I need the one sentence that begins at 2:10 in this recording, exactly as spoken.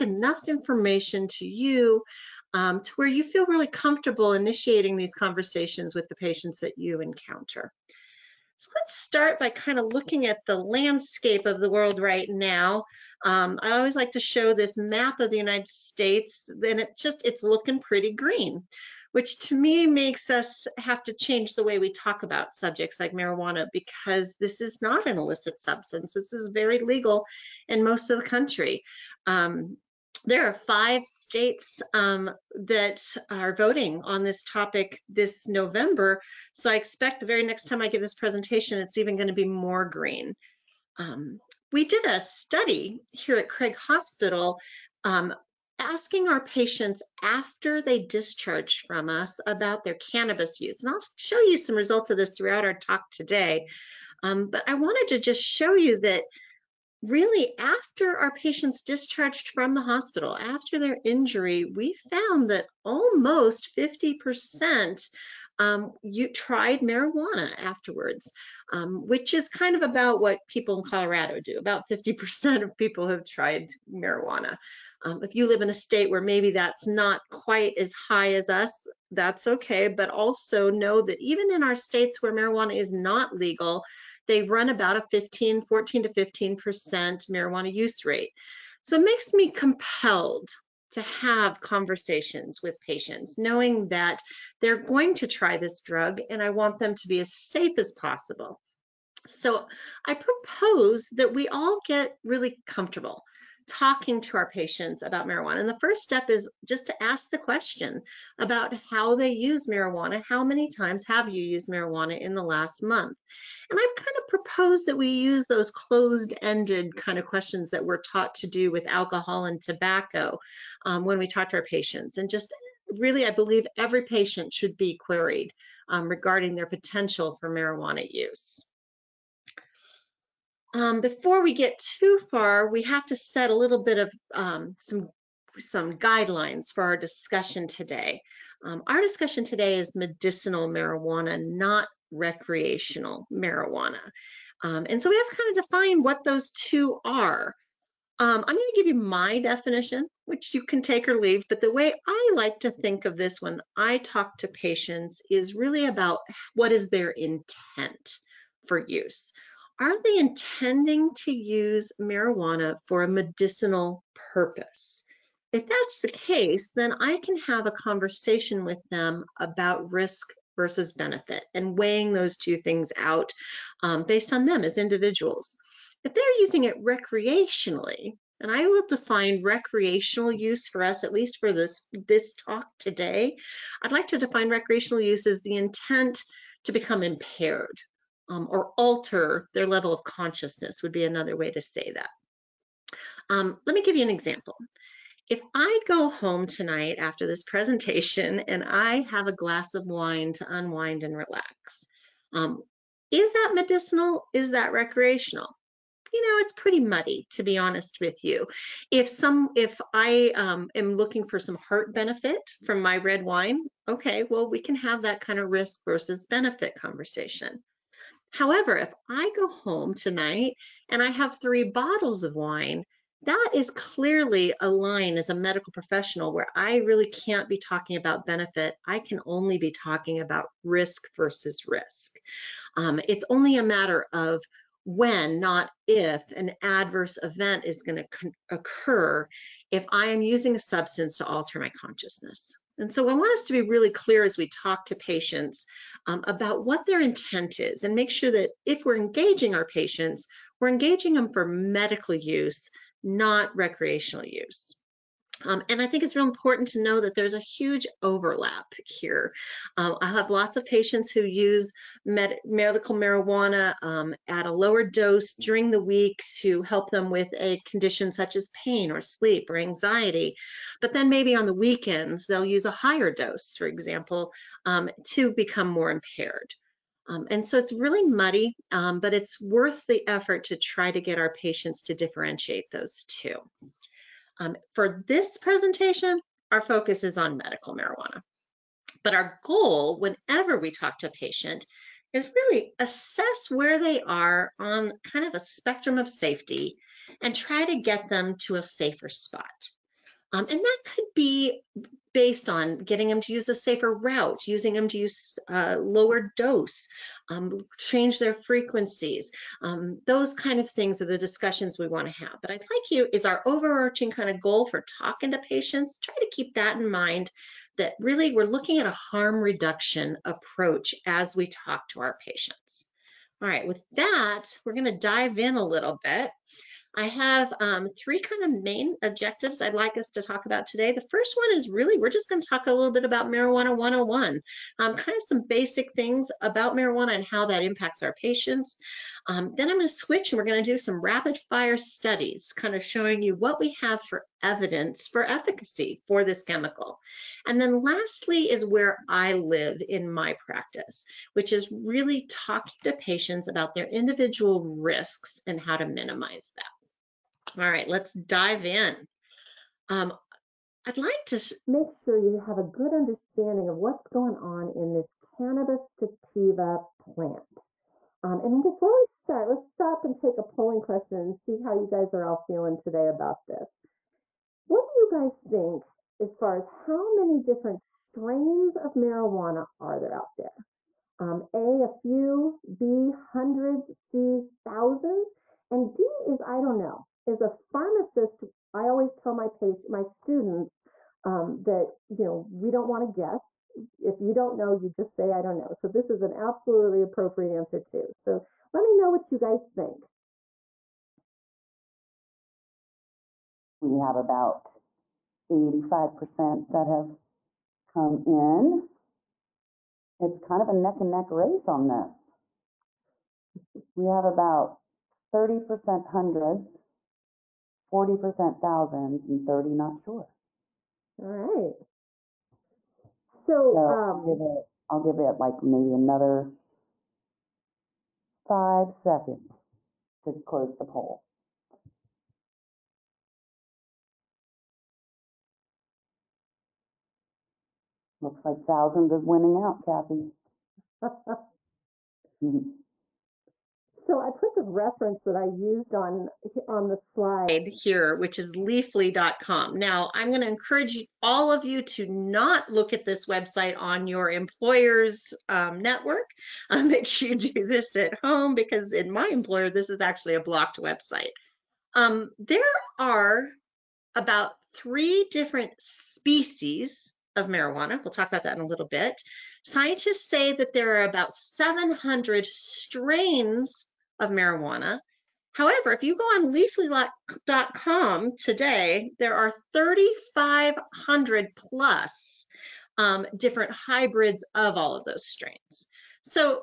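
Um, before we get too far, we have to set a little bit of um, some some guidelines for our discussion today.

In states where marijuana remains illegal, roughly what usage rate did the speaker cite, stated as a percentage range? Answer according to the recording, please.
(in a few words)
14 to 15%.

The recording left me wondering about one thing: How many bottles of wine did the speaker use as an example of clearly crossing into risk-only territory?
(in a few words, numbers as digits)
3.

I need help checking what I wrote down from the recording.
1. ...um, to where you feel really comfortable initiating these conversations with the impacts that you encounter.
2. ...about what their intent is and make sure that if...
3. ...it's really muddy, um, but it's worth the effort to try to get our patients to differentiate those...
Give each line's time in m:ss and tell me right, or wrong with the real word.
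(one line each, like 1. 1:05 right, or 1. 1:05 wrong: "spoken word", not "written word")
1. 0:02 wrong: "patients", not "impacts"
2. 4:06 right
3. 4:37 right.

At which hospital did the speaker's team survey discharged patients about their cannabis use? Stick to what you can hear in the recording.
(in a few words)
Craig Hospital.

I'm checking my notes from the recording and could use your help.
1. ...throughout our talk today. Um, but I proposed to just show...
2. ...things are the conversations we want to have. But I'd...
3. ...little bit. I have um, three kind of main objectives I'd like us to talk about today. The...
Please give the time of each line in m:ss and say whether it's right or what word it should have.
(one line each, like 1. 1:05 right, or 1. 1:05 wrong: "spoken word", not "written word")
1. 0:52 wrong: "wanted", not "proposed"
2. 5:10 wrong: "discussions", not "conversations"
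3. 5:25 right.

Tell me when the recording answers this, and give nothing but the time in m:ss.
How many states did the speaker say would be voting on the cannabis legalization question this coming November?
0:30.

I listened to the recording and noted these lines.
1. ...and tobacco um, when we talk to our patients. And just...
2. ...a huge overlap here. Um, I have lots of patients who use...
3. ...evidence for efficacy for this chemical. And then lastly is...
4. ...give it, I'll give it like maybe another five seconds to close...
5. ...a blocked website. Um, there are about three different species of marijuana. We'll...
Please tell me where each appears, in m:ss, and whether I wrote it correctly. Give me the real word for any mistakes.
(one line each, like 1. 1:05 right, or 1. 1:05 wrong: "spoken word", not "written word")
1. 1:59 right
2. 4:17 right
3. 5:44 right
4. 7:04 right
5. 7:40 right.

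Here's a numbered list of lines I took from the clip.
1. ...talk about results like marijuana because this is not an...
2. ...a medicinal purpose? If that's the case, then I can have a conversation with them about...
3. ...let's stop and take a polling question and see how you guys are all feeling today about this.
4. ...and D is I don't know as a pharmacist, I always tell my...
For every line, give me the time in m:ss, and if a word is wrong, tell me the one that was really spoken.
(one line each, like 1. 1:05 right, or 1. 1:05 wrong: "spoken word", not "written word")
1. 0:21 wrong: "subjects", not "results"
2. 2:43 right
3. 6:09 right
4. 6:25 right.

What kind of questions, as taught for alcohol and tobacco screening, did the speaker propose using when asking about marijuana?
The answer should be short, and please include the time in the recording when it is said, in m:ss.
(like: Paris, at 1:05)
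closed ended, at 1:55.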